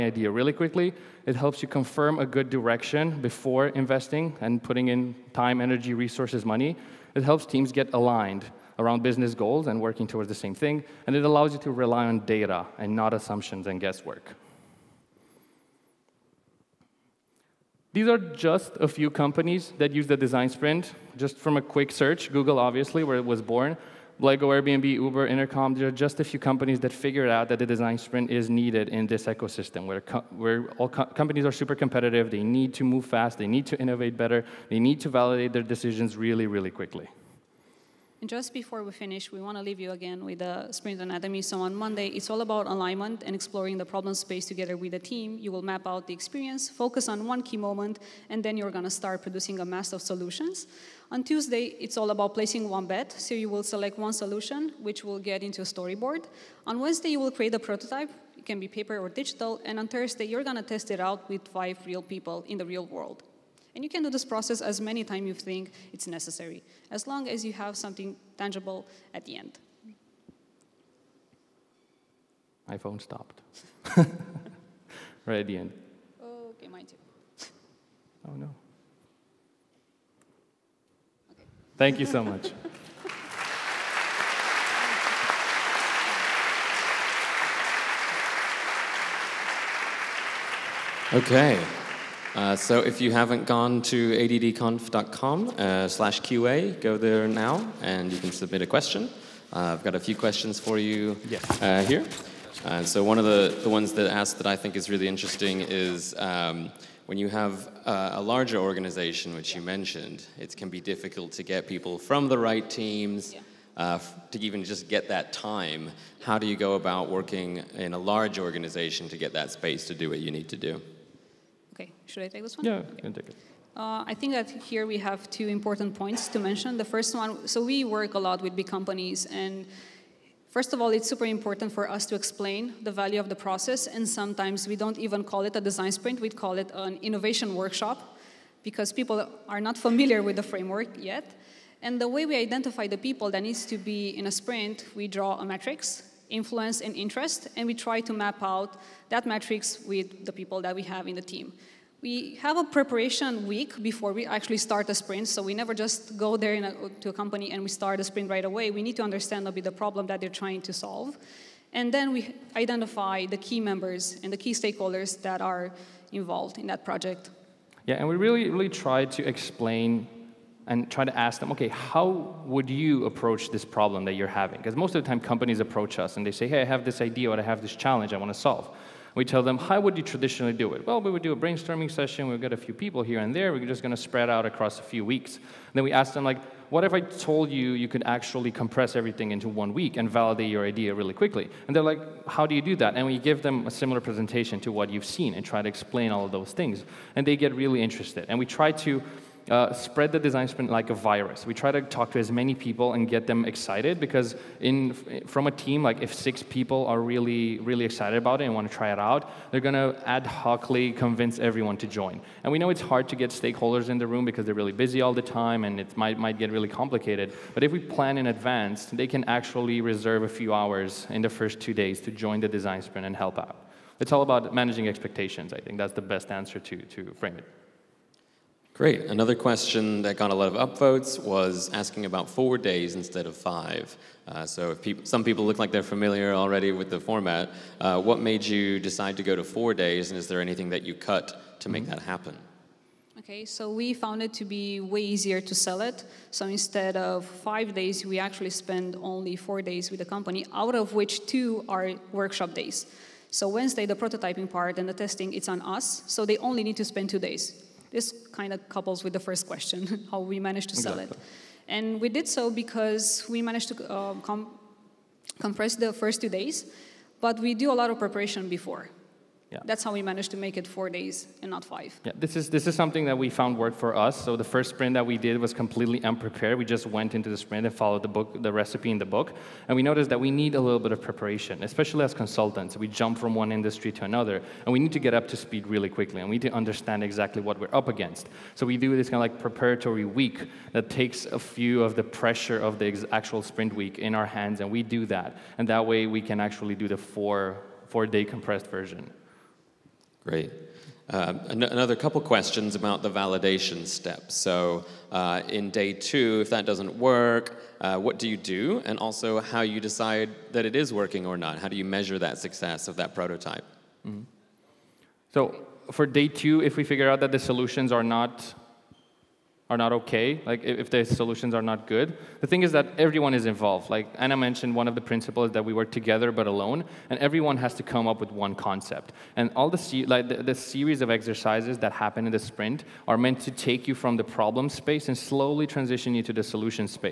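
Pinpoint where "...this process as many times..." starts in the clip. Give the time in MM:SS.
01:04.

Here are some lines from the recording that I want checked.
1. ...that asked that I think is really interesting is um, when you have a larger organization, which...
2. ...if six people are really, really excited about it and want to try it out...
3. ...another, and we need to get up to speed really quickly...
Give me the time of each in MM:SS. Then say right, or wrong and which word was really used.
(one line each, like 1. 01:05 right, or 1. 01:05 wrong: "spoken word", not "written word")
1. 01:43 right
2. 03:26 right
3. 04:44 right.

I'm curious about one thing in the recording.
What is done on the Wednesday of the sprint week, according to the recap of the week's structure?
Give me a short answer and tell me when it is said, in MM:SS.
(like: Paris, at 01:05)
create a prototype, at 00:57.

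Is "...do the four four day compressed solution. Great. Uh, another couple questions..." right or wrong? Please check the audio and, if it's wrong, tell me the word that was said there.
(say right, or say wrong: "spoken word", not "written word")
wrong: "version", not "solution".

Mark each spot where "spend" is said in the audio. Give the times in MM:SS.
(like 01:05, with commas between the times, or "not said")
04:08, 04:16.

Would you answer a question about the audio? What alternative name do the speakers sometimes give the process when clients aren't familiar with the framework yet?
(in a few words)
innovation workshop.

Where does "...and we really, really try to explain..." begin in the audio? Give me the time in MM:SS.
02:47.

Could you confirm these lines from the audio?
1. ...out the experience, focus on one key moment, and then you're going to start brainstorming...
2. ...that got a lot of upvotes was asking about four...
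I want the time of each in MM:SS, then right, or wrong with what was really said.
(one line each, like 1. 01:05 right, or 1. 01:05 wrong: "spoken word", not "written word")
1. 00:45 wrong: "producing", not "brainstorming"
2. 03:50 right.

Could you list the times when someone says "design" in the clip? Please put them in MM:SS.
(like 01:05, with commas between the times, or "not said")
00:20, 00:27, 02:15, 03:20, 03:42.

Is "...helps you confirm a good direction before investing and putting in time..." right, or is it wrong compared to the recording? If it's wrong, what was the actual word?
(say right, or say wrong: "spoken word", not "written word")
right.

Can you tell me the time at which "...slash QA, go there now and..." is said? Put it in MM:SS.
01:35.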